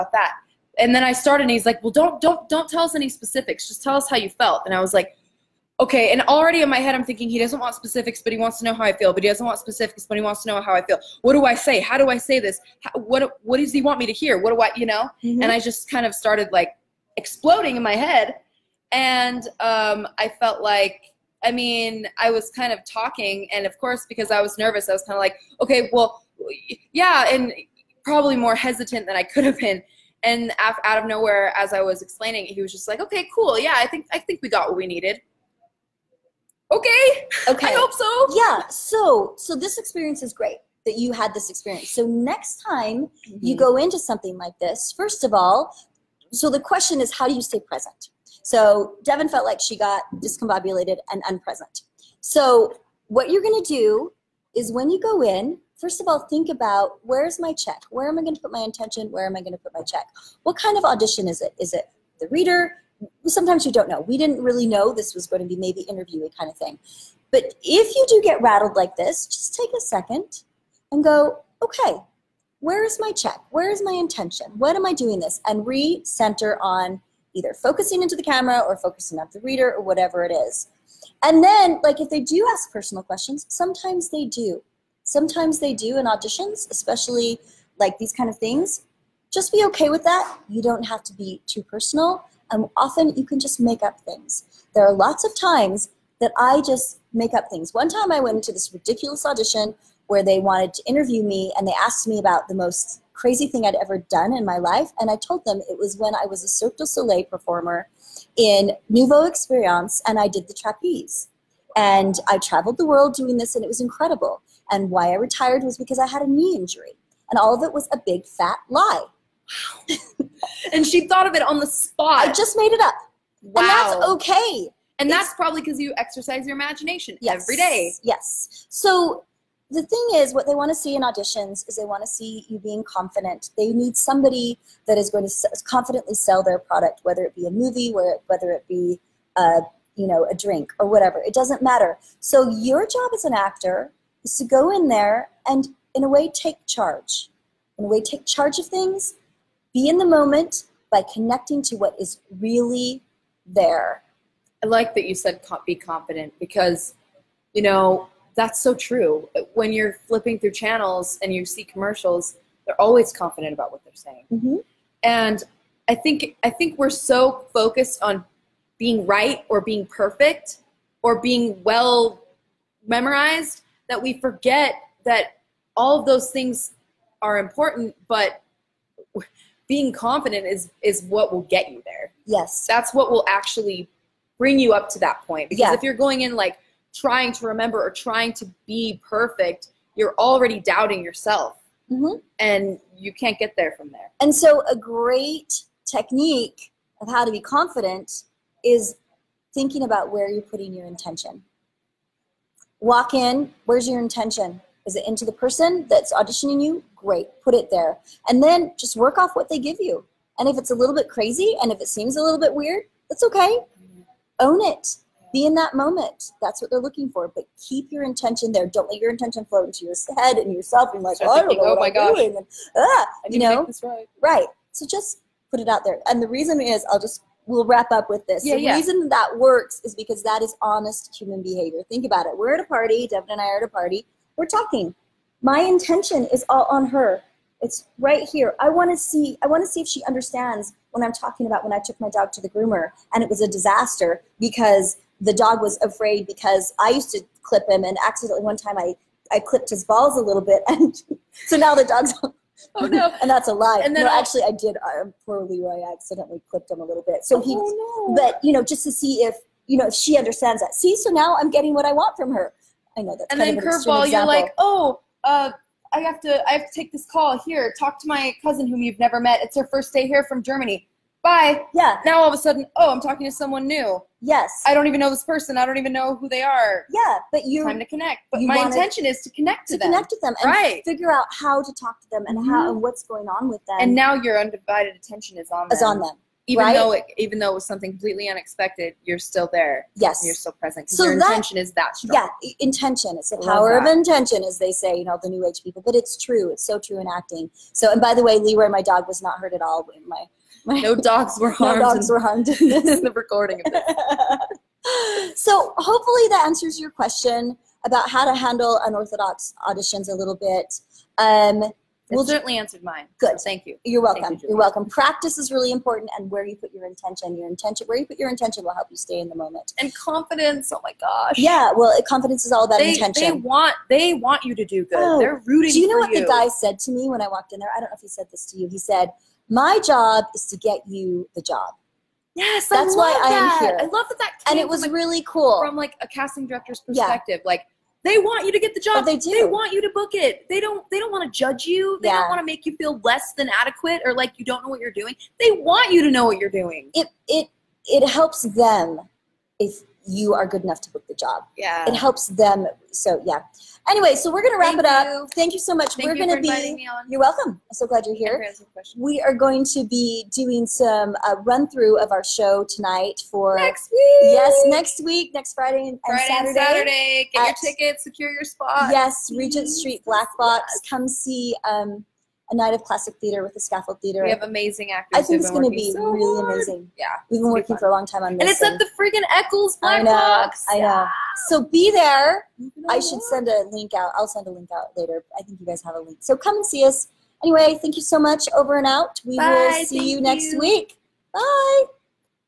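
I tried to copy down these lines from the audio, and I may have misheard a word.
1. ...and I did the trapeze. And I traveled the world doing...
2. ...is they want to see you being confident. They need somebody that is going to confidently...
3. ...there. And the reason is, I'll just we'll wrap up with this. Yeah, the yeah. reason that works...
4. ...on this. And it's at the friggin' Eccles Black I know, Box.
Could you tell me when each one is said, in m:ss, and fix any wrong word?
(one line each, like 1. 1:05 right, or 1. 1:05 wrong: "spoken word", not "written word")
1. 1:50 right
2. 2:11 right
3. 3:45 right
4. 6:18 right.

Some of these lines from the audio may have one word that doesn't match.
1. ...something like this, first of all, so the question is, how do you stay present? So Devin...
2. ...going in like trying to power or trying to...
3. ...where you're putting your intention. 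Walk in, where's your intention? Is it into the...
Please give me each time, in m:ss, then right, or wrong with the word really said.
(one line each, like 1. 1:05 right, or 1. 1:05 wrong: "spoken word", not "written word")
1. 0:44 right
2. 3:05 wrong: "remember", not "power"
3. 3:20 right.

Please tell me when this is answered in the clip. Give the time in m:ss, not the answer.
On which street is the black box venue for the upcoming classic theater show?
6:09.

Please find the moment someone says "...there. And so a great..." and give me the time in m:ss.
3:13.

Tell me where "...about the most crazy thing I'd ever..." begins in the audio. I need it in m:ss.
1:42.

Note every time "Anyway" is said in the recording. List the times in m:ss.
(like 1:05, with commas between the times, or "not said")
5:53, 6:27.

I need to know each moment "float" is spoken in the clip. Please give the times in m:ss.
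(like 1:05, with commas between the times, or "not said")
3:39.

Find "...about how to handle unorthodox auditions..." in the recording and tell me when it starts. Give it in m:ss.
5:07.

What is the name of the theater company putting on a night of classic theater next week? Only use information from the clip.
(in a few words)
Scaffold Theater.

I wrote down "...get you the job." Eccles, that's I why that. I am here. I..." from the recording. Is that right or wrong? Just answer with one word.
wrong.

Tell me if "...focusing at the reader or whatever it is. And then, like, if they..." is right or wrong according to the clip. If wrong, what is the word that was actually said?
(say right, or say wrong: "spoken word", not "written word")
right.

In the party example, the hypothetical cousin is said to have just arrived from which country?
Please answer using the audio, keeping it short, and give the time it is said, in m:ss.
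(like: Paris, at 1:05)
Germany, at 4:30.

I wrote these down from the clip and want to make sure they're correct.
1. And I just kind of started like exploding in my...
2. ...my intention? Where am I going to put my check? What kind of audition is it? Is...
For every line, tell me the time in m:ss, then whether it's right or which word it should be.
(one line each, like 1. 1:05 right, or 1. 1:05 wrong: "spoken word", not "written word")
1. 0:15 right
2. 0:58 right.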